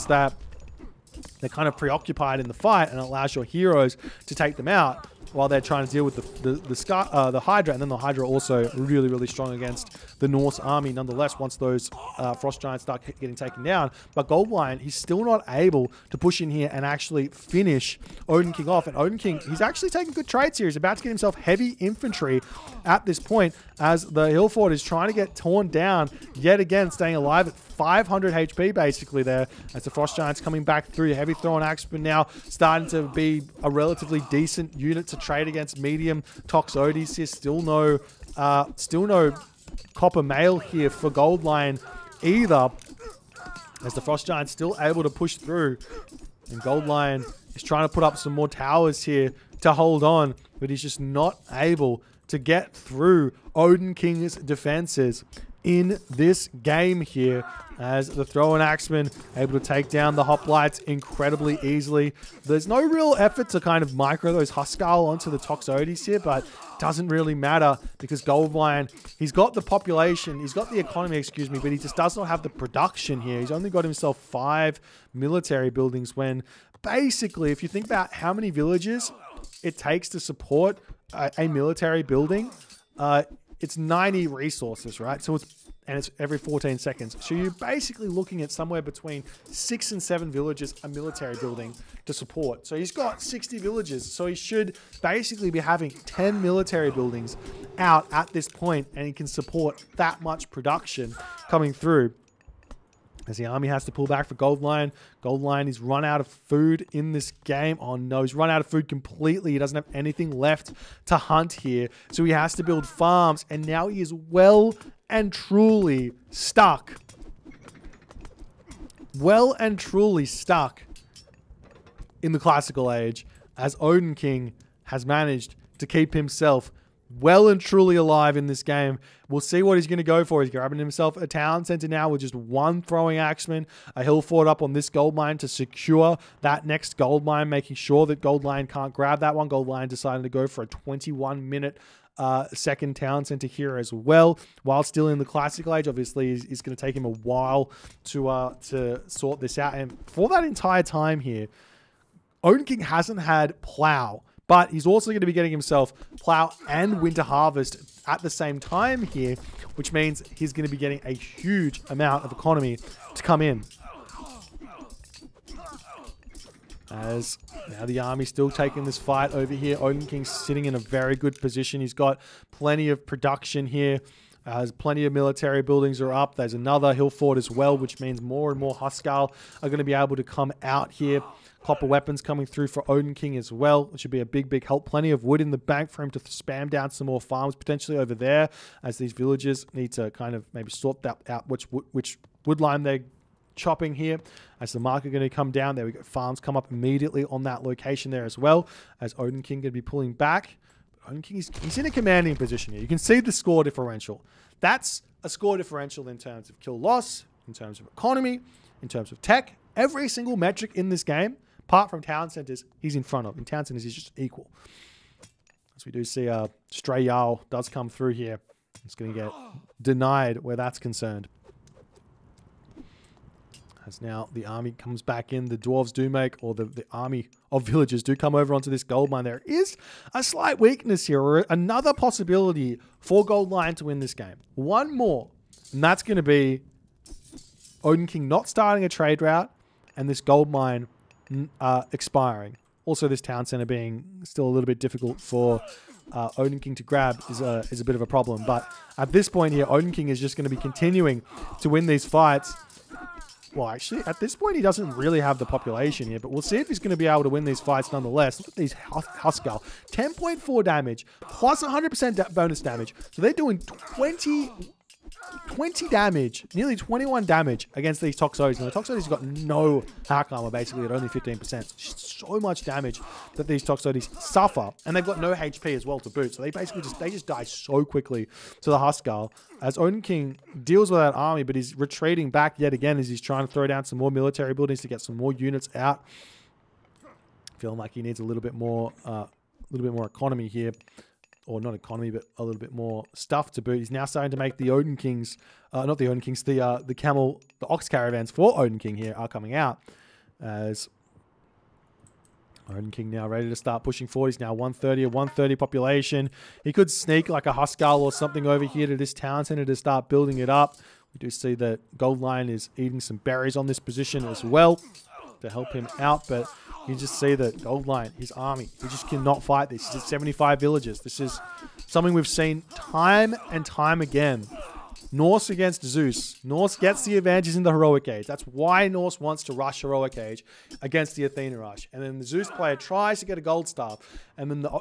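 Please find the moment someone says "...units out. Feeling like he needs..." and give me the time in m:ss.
4:45.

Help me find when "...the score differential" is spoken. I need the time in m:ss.
3:23.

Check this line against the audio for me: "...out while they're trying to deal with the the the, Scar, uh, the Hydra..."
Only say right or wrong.
right.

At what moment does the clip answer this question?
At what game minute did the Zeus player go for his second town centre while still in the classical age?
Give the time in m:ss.
2:20.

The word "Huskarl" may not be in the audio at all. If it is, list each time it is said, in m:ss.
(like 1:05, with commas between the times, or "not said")
1:04, 2:58, 4:18, 4:38, 5:07.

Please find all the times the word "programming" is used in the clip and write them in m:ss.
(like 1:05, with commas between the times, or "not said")
not said.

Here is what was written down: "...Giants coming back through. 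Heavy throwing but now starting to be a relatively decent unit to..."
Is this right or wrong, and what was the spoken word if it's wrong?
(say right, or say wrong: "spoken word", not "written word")
right.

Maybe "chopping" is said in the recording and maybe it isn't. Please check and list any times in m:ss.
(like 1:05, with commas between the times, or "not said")
3:13.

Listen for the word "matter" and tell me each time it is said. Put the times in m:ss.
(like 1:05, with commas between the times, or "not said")
1:07.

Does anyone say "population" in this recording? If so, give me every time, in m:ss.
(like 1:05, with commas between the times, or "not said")
1:09, 4:15, 5:05.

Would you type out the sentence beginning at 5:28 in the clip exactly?
That's why Norse wants to rush Heroic Age against the Athena Rush.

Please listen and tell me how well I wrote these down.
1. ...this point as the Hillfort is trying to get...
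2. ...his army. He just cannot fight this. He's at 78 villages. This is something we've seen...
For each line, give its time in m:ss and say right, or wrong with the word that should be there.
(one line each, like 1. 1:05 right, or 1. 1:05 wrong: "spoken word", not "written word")
1. 0:23 right
2. 5:18 wrong: "75", not "78".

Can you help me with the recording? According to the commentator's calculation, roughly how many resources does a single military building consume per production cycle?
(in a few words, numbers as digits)
90.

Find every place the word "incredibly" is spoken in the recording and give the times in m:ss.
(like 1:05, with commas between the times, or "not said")
1:00.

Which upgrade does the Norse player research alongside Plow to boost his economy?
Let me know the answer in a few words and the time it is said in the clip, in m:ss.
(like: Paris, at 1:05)
Winter Harvest, at 2:37.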